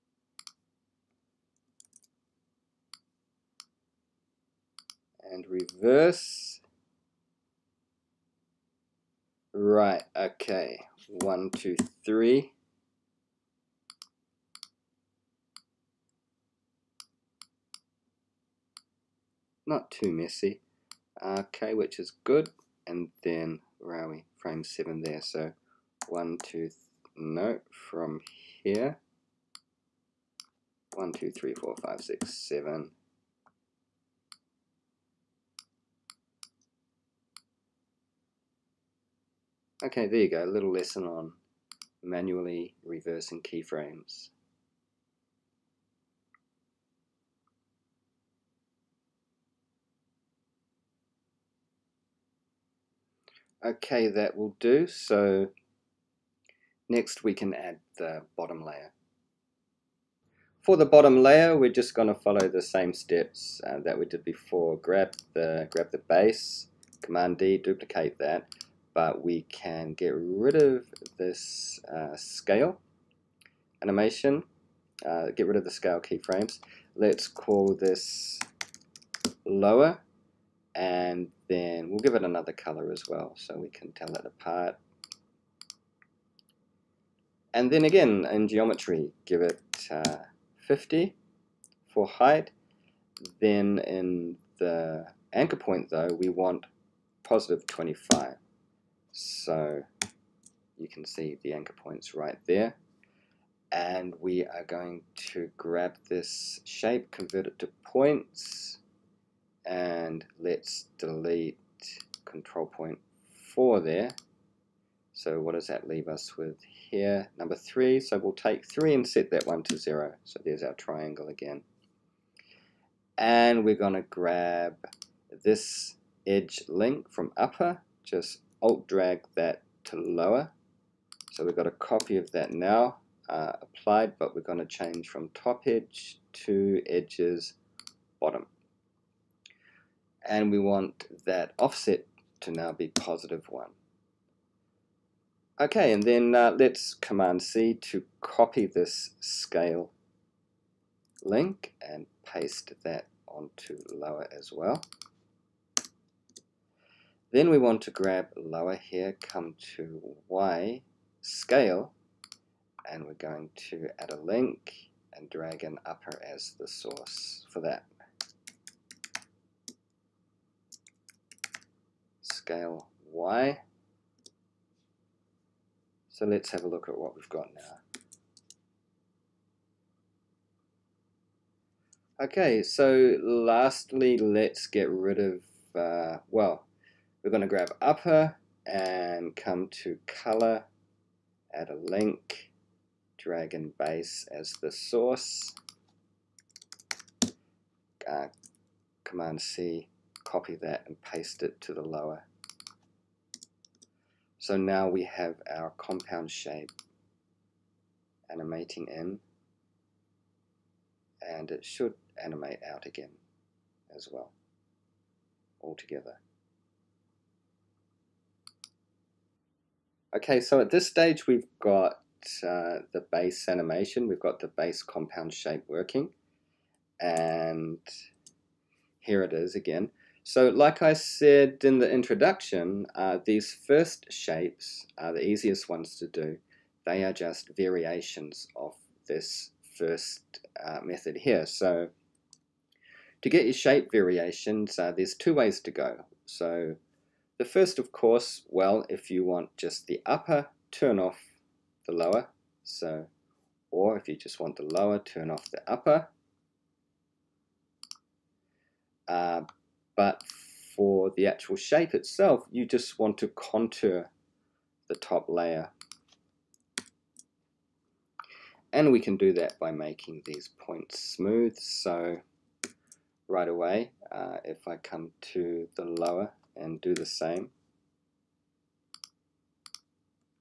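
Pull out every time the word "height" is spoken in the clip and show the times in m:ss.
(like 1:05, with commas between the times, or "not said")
1:32.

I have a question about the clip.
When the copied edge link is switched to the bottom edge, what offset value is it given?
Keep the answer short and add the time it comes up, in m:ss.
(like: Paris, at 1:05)
1, at 2:22.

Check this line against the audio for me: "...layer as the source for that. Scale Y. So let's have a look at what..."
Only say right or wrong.
wrong.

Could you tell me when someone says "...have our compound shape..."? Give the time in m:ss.
3:25.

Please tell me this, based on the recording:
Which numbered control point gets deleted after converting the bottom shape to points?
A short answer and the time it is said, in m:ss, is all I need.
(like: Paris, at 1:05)
4, at 1:52.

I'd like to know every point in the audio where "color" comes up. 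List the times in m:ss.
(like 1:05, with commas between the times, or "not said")
1:22, 3:10.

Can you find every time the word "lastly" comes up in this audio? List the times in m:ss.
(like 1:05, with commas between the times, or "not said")
3:03.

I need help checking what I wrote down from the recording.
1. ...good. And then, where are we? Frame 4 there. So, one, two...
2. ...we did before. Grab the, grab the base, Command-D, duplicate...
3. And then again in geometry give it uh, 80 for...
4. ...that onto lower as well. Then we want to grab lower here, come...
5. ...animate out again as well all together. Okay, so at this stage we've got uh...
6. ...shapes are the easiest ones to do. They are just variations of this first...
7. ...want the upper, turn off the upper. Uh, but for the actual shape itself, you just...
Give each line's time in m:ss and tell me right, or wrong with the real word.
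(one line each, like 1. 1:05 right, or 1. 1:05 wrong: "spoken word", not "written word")
1. 0:22 wrong: "7", not "4"
2. 1:03 right
3. 1:27 wrong: "50", not "80"
4. 2:32 right
5. 3:32 right
6. 3:54 right
7. 4:14 wrong: "lower", not "upper".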